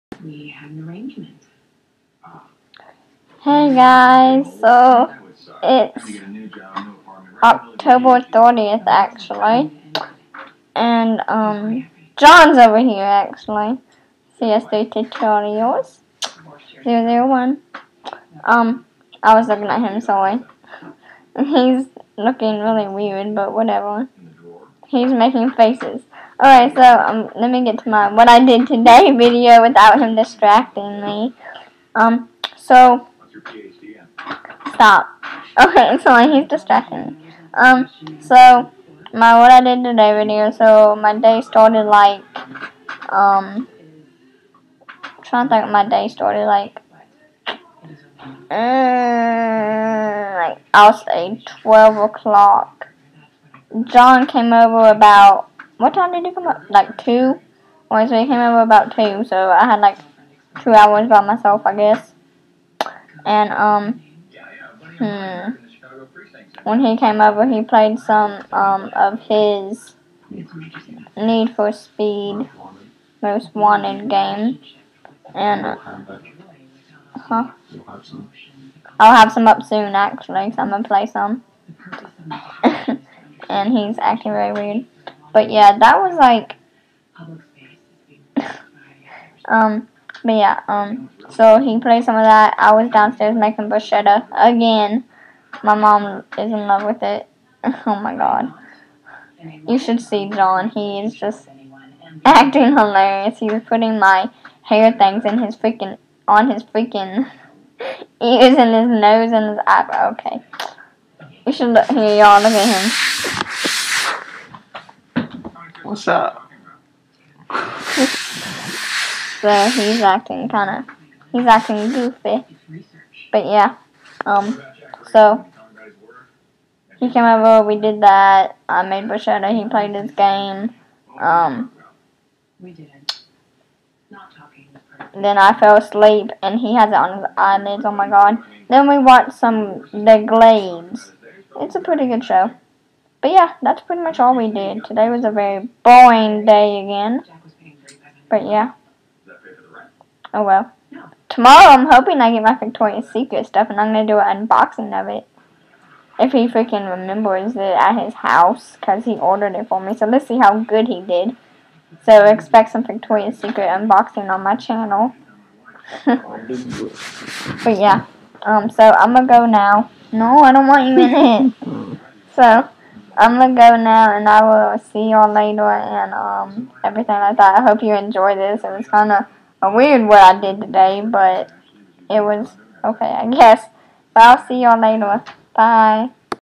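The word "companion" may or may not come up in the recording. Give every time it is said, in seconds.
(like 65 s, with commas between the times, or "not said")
not said.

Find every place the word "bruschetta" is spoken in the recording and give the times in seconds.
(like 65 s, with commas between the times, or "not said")
93 s, 129 s.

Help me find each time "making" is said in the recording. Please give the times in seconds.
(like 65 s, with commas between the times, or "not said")
25 s, 93 s.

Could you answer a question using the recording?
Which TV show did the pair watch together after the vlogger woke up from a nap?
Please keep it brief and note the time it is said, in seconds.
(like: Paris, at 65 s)
The Glades, at 139 s.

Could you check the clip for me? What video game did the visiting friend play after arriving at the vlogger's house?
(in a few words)
Need for Speed Most Wanted.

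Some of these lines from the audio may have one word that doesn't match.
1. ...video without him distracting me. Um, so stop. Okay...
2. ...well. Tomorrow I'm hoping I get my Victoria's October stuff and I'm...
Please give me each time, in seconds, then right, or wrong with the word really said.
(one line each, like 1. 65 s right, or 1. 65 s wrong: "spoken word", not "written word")
1. 29 s right
2. 150 s wrong: "Secret", not "October".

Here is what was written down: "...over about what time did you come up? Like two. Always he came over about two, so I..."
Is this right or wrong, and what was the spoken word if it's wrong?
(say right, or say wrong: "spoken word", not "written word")
right.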